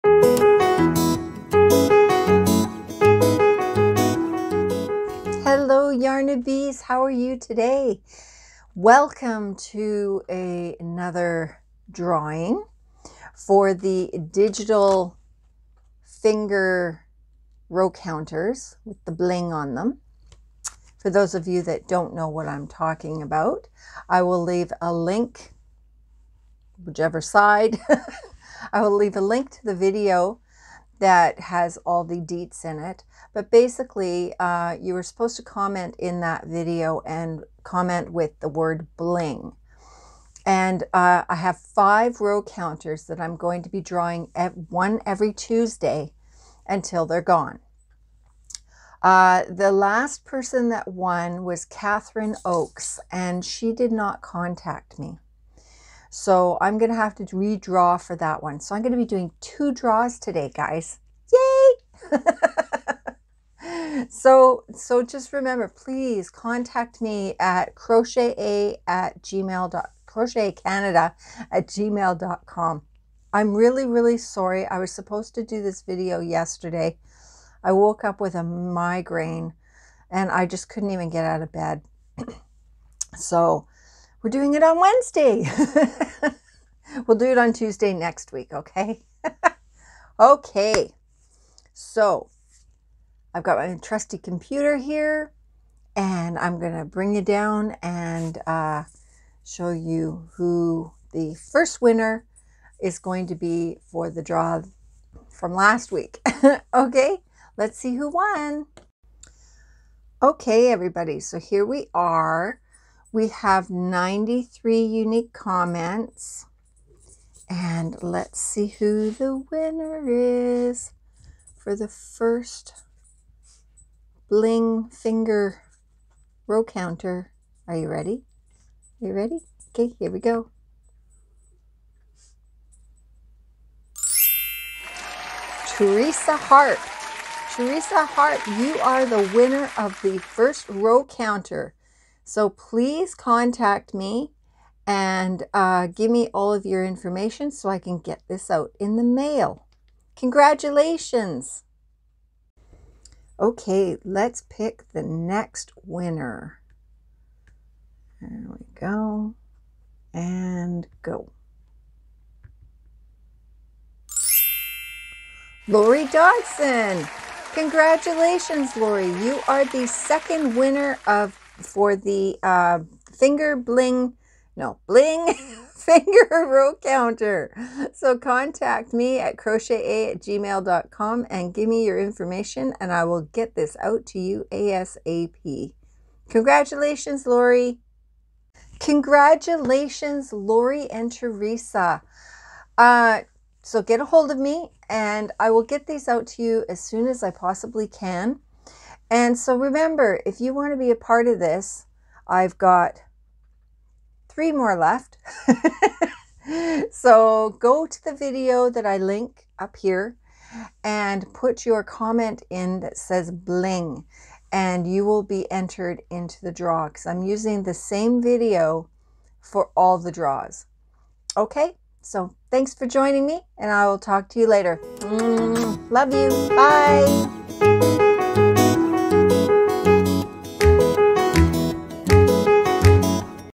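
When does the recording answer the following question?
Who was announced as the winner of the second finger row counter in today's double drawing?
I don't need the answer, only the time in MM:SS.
02:45.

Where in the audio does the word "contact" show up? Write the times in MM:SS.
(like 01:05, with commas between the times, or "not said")
00:54, 01:06, 02:23, 02:58.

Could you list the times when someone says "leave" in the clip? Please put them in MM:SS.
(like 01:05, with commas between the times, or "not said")
00:24, 00:28.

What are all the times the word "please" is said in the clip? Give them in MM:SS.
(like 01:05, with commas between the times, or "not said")
01:05, 02:22.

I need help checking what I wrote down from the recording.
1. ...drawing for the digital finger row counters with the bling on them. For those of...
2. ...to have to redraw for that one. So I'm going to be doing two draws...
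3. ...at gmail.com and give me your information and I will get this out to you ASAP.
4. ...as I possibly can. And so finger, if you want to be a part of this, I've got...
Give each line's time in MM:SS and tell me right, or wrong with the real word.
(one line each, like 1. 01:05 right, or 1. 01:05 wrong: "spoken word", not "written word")
1. 00:11 right
2. 00:56 right
3. 03:00 right
4. 03:17 wrong: "remember", not "finger".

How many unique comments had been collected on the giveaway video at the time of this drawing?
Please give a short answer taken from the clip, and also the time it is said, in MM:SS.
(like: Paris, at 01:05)
93, at 01:53.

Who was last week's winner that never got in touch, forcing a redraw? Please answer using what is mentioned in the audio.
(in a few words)
Catherine Oakes.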